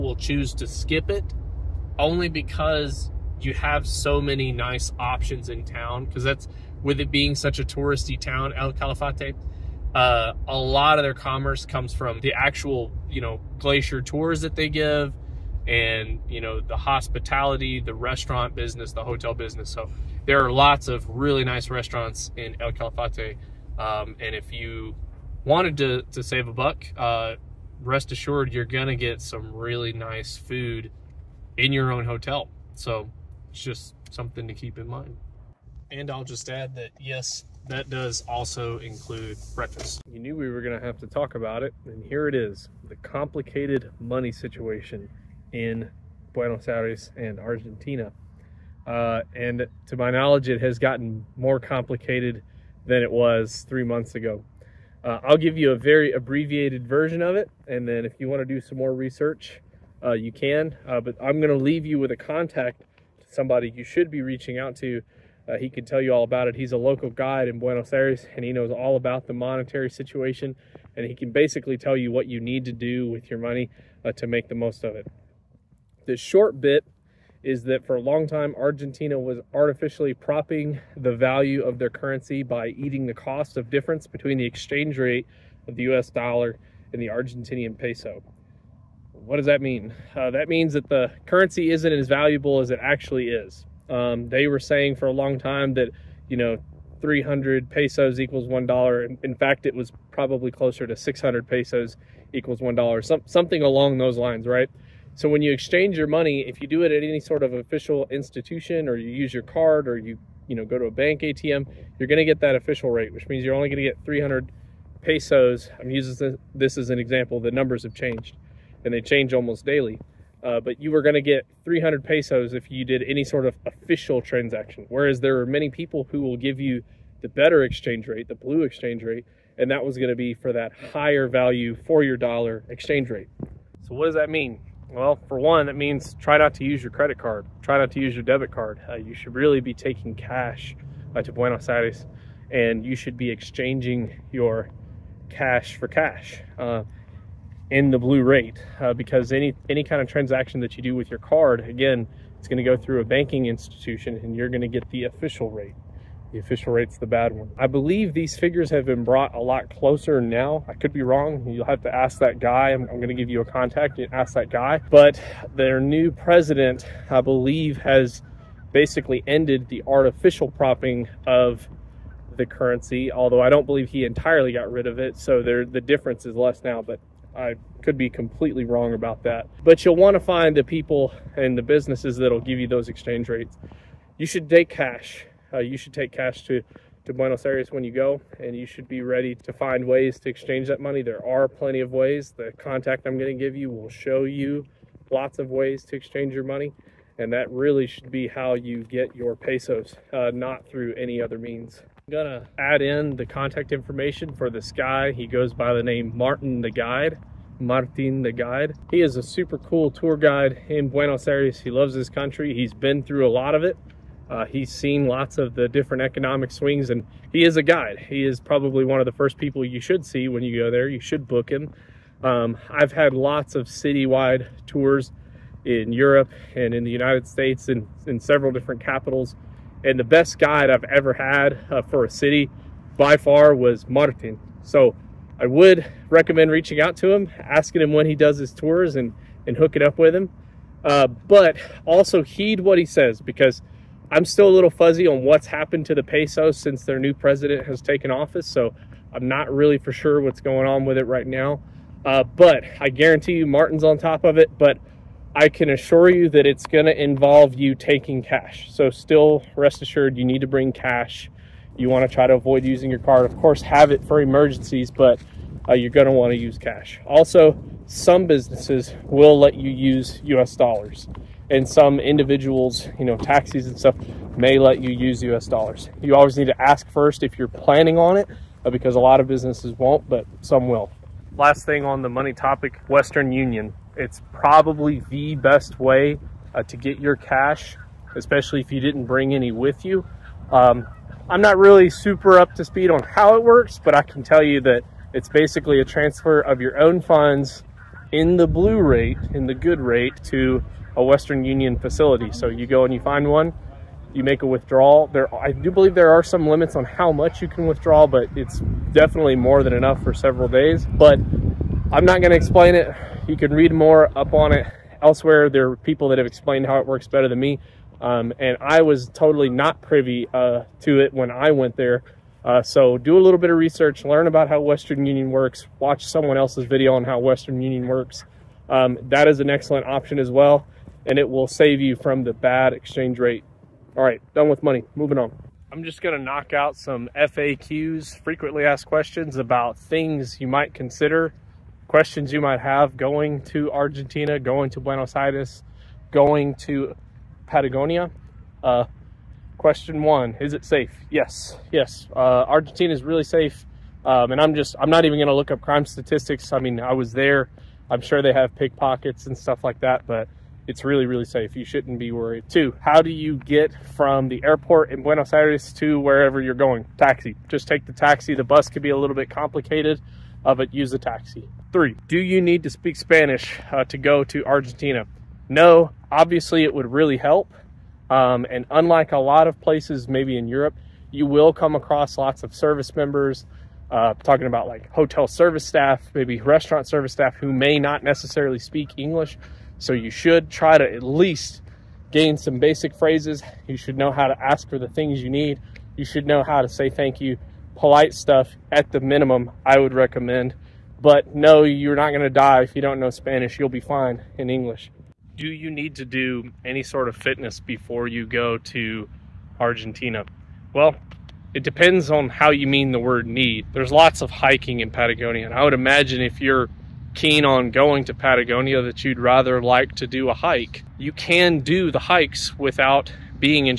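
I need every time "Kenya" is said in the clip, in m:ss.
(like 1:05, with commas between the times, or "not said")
not said.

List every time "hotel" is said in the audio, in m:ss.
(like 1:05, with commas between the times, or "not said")
0:19, 0:32, 6:24.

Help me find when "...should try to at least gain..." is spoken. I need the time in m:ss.
6:30.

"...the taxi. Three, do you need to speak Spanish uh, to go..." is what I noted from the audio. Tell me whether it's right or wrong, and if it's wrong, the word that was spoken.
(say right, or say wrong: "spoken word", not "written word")
right.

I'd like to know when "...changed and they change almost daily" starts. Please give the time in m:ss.
1:57.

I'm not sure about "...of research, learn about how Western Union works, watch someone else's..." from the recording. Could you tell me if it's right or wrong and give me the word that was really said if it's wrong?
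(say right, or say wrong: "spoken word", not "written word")
right.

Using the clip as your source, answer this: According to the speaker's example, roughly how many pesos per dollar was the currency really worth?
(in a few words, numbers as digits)
600.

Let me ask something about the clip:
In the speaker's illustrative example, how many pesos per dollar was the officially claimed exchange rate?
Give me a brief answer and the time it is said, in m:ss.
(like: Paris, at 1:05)
300, at 1:37.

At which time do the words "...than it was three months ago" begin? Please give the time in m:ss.
0:52.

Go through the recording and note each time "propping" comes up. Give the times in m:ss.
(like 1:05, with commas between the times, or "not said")
1:20, 2:50.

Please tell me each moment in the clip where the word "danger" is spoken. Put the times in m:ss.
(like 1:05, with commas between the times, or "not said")
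not said.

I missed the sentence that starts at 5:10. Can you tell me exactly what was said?
But I'm not going to explain it.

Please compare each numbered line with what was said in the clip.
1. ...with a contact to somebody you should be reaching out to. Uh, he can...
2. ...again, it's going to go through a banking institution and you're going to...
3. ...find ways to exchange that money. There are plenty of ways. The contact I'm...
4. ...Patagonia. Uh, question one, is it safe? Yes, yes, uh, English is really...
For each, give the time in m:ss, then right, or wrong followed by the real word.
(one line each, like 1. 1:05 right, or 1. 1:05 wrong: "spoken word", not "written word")
1. 1:01 right
2. 2:31 right
3. 3:09 right
4. 5:47 wrong: "Argentina", not "English".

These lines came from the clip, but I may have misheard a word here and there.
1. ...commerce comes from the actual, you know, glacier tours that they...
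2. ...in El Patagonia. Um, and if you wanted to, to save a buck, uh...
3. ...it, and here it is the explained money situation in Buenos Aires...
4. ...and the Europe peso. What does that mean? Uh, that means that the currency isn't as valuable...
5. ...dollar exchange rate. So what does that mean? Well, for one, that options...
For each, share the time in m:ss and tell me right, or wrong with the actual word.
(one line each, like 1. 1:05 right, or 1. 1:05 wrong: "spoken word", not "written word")
1. 0:11 right
2. 0:22 wrong: "Calafate", not "Patagonia"
3. 0:41 wrong: "complicated", not "explained"
4. 1:26 wrong: "Argentinian", not "Europe"
5. 2:12 wrong: "means", not "options".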